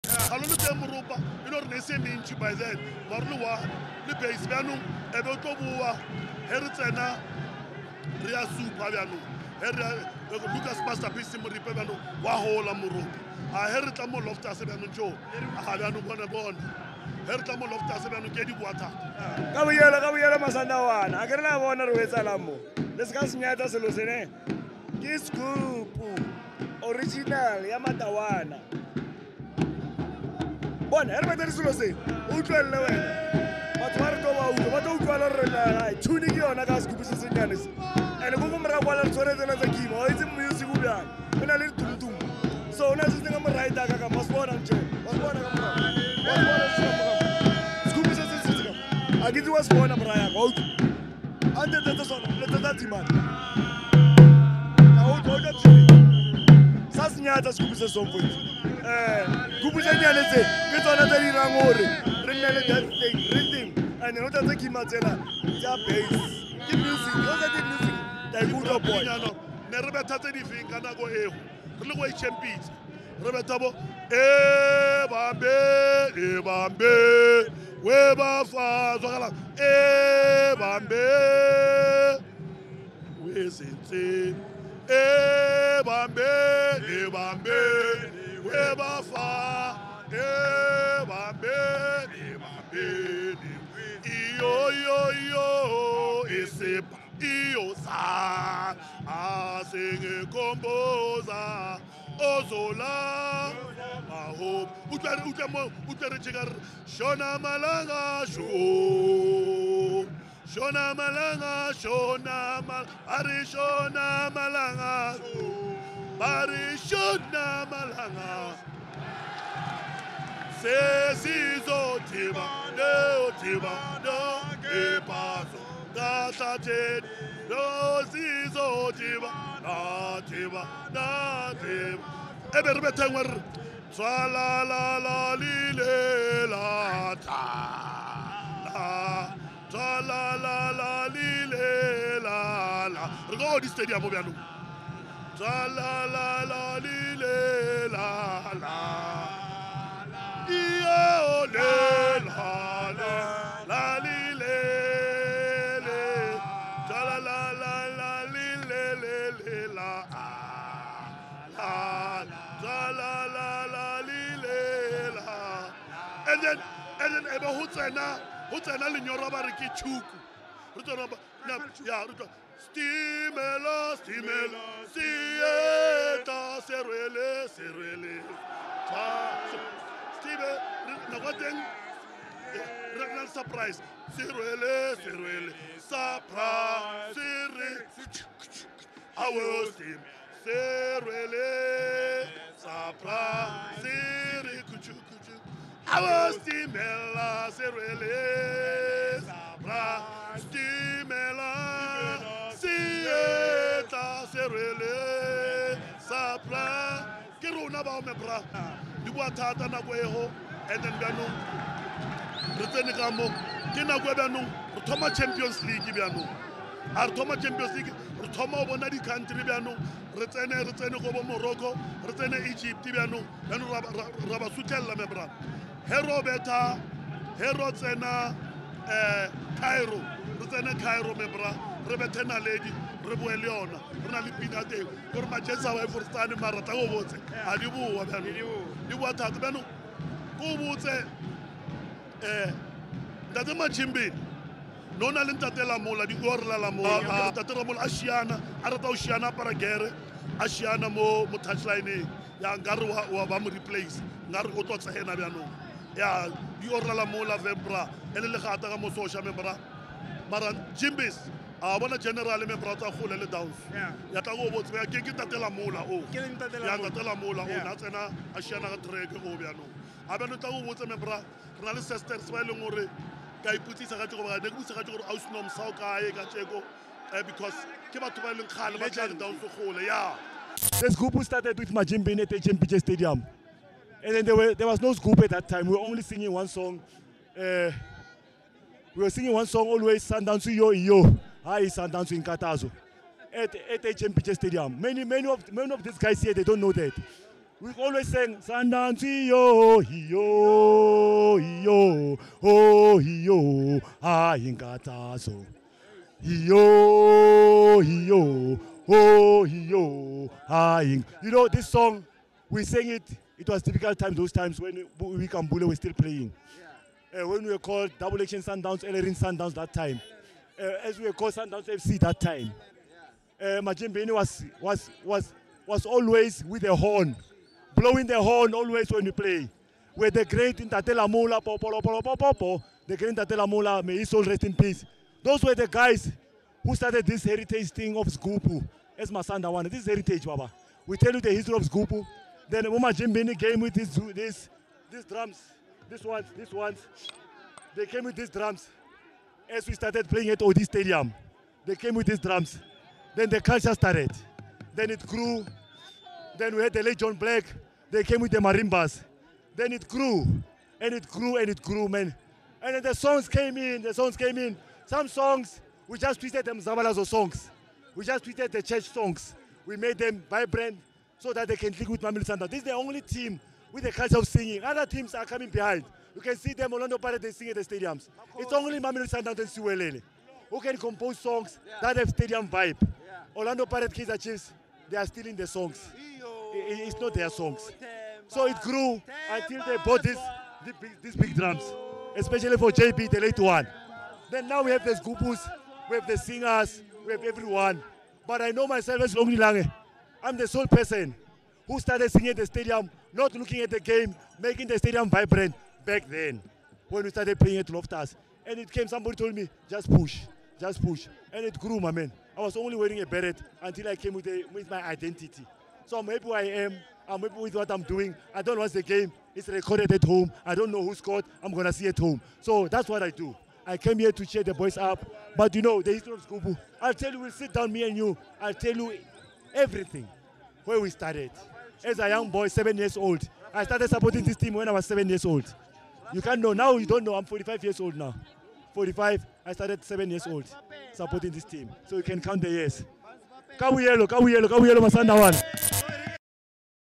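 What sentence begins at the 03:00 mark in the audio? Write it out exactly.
Stime, nako teng, re na surprise.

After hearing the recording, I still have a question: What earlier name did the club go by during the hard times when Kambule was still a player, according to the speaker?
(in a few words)
Double Action Sundowns.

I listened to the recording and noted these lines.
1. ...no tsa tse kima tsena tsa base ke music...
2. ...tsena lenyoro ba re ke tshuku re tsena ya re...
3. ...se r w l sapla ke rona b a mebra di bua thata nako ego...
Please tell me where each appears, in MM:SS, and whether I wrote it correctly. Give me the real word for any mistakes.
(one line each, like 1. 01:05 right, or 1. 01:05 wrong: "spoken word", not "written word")
1. 01:04 right
2. 02:48 right
3. 03:24 right.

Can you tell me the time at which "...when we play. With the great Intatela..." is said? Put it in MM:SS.
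05:28.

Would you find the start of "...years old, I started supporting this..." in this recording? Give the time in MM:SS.
07:12.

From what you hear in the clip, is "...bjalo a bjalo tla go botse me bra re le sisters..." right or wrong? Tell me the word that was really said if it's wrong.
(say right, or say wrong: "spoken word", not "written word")
right.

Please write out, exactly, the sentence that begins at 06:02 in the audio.
And then the songs came in, the songs came in.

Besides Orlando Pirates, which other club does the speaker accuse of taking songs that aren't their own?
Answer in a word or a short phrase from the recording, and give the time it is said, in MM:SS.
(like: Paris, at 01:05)
Kaiser Chiefs, at 06:23.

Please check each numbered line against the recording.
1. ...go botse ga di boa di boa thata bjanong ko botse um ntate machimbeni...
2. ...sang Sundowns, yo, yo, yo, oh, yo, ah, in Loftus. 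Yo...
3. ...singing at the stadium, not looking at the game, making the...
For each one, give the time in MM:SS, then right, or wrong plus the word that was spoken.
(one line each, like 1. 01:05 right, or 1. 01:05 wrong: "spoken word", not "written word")
1. 03:56 right
2. 04:58 wrong: "Katazo", not "Loftus"
3. 06:42 right.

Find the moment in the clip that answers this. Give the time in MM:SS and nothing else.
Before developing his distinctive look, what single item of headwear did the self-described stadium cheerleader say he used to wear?
06:53.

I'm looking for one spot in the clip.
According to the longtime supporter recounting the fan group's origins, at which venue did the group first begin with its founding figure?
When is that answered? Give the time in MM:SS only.
04:42.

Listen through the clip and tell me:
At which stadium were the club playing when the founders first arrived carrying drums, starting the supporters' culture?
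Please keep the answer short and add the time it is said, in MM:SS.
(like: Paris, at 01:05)
Odi Stadium, at 05:50.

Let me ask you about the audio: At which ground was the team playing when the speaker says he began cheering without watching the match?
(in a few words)
Loftus.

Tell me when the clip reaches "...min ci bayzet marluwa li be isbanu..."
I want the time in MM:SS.
00:01.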